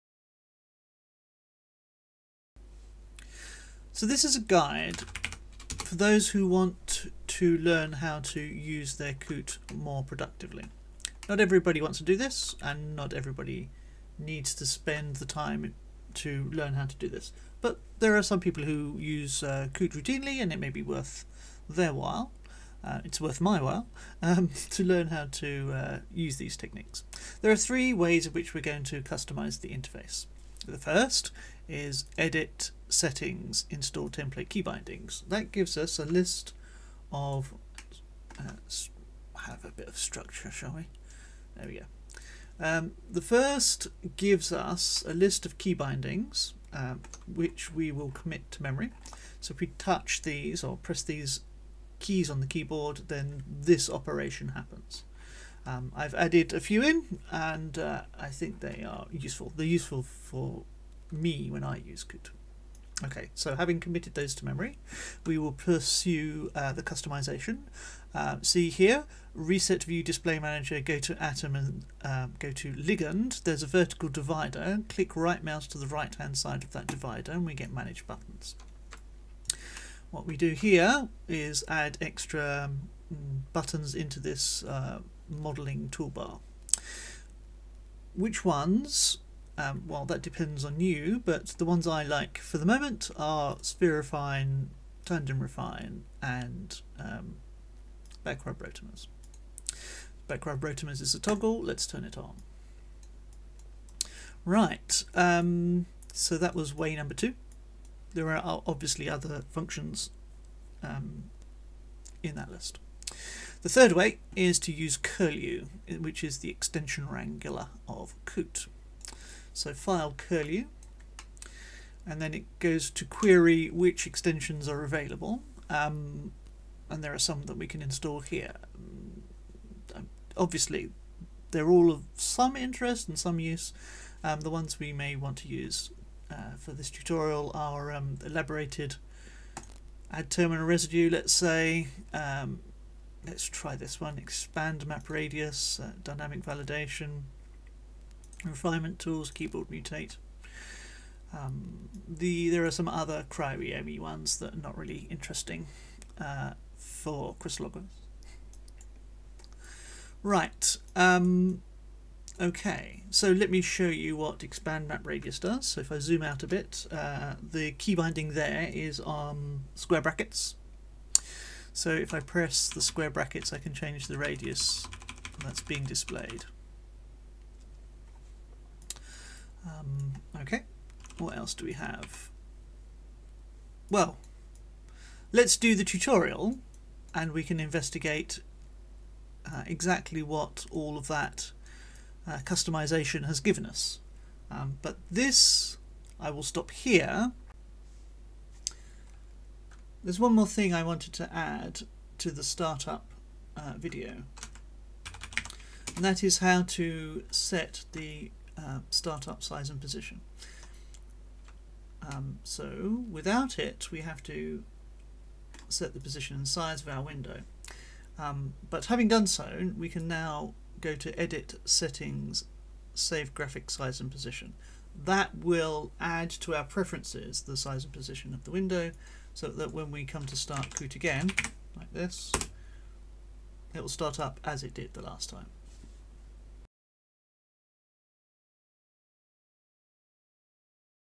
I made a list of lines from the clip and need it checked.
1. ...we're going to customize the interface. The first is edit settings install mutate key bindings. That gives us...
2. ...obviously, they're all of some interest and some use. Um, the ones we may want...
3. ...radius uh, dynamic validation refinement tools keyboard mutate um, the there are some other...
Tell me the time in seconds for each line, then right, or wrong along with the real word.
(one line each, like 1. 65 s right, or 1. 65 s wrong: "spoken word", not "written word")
1. 28 s wrong: "template", not "mutate"
2. 130 s right
3. 145 s right.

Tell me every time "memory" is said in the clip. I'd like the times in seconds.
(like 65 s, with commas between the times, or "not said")
48 s, 64 s.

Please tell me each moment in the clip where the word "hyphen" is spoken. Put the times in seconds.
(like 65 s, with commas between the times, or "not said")
not said.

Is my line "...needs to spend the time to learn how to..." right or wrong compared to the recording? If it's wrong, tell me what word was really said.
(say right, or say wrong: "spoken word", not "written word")
right.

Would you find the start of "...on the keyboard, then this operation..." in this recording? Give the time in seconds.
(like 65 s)
52 s.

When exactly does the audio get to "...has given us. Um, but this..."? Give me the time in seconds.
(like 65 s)
193 s.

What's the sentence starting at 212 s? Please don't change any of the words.
Um, so without it, we have to set the position and size of our window.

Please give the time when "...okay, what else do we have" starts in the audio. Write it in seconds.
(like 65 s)
180 s.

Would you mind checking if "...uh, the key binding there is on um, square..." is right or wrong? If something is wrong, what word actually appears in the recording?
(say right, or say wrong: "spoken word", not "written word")
right.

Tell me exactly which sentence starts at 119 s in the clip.
So file curlew, and then it goes to query which extensions are available.